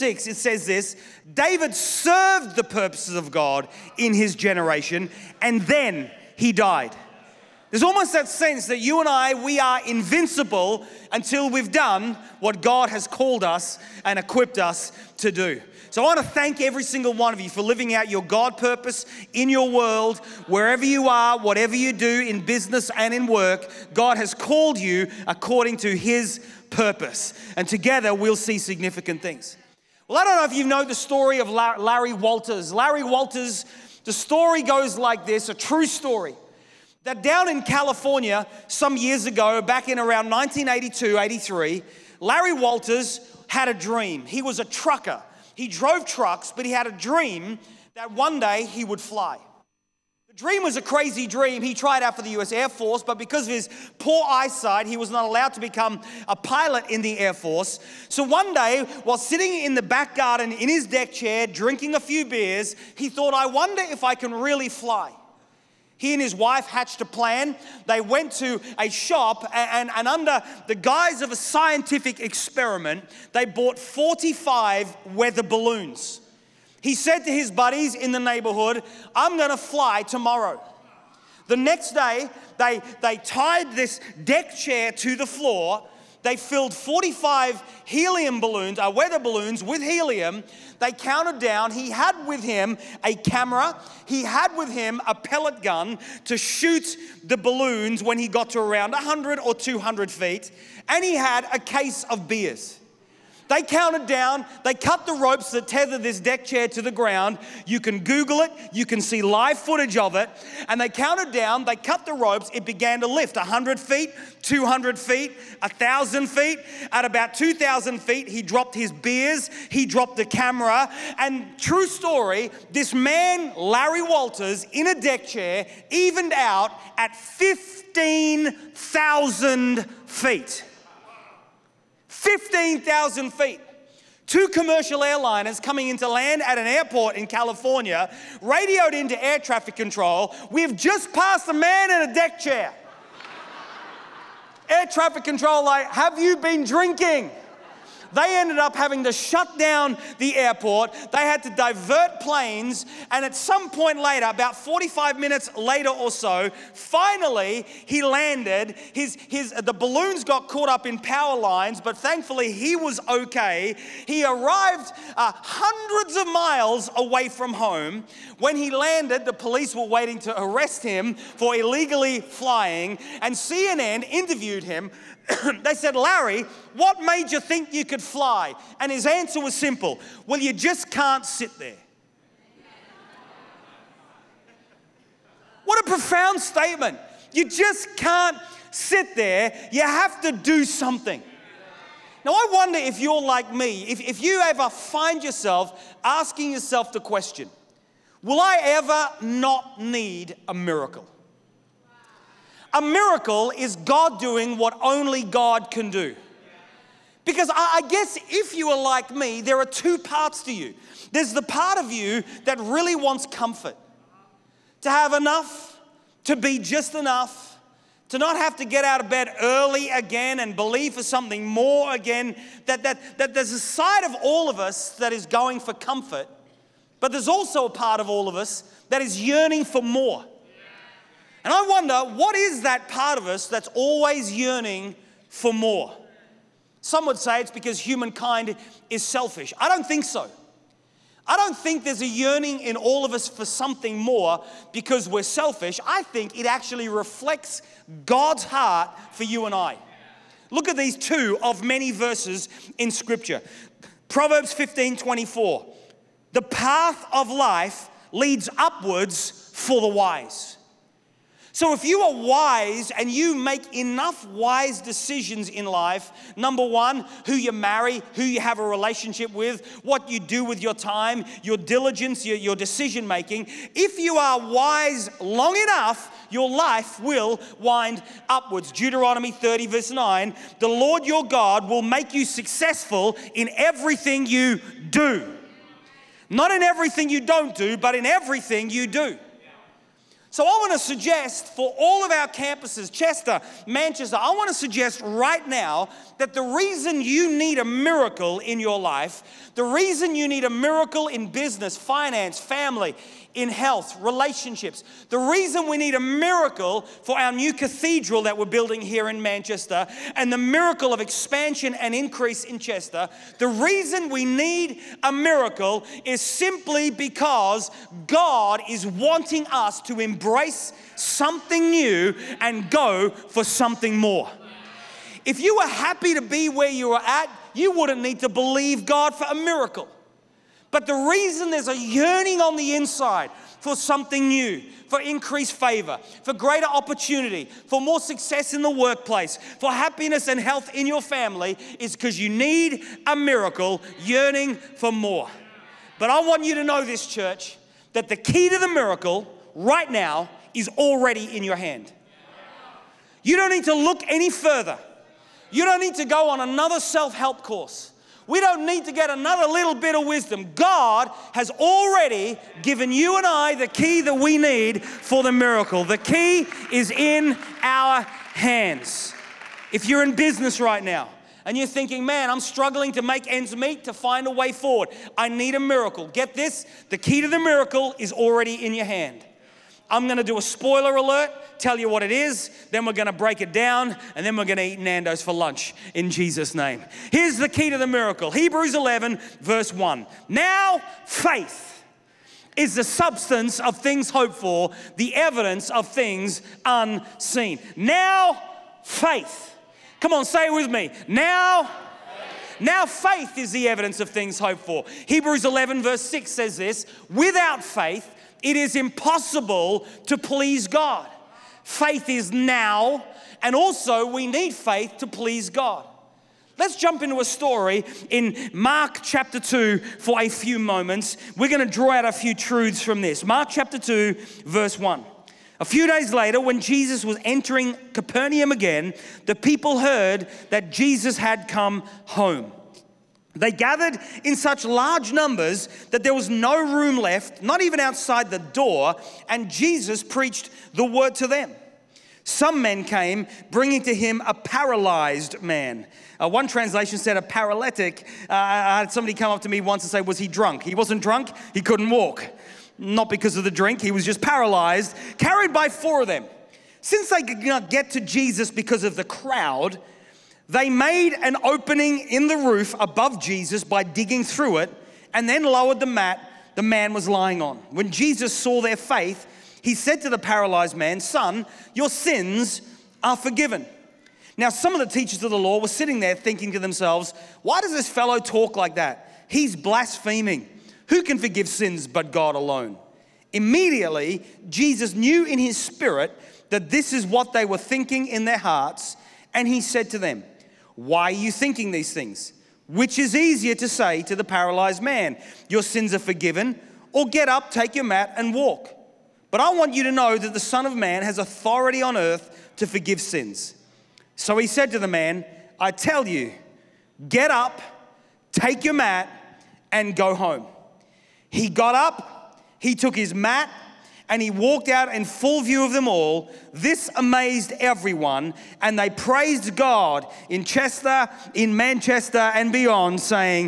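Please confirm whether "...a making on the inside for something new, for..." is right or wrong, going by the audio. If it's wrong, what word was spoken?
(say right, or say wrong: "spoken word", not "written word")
wrong: "yearning", not "making".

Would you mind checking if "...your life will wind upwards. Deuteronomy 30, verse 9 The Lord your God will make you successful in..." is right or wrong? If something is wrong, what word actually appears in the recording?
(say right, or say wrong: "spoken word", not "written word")
right.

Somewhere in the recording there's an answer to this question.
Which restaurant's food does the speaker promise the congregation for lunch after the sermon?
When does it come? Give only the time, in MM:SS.
06:24.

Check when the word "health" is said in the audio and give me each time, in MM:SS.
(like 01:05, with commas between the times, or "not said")
05:03, 05:40.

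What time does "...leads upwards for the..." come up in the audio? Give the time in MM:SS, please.
04:18.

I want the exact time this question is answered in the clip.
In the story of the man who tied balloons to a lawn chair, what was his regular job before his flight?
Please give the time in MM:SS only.
00:44.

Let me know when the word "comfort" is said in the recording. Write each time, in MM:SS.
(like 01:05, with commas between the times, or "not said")
03:33, 03:45.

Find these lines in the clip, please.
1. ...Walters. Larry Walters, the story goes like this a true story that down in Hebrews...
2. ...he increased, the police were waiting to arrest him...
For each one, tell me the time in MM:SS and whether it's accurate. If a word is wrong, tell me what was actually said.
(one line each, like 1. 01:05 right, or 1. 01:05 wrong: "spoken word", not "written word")
1. 00:32 wrong: "California", not "Hebrews"
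2. 02:48 wrong: "landed", not "increased".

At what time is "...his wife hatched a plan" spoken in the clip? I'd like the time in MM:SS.
01:06.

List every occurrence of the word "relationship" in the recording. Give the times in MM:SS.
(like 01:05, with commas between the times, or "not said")
04:28, 05:04.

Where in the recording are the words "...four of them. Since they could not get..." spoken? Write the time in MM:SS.
07:35.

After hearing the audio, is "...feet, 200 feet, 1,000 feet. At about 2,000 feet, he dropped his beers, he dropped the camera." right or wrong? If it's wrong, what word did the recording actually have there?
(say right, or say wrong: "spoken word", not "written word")
right.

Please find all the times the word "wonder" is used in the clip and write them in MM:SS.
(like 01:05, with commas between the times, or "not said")
01:03, 03:12, 03:51.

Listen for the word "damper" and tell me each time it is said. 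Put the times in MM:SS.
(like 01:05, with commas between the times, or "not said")
not said.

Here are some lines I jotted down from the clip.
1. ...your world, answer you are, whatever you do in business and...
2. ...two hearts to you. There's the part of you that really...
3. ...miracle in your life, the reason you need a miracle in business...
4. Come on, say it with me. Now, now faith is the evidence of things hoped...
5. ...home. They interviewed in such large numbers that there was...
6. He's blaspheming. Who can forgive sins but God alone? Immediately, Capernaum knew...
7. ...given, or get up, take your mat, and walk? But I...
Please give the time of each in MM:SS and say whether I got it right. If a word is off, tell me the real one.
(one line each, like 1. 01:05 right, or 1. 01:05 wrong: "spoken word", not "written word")
1. 00:19 wrong: "wherever", not "answer"
2. 03:29 wrong: "parts", not "hearts"
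3. 04:57 right
4. 06:39 right
5. 07:12 wrong: "gathered", not "interviewed"
6. 07:59 wrong: "Jesus", not "Capernaum"
7. 08:15 wrong: "forgiven", not "given".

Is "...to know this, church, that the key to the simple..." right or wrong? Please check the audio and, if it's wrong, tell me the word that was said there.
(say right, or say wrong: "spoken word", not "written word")
wrong: "miracle", not "simple".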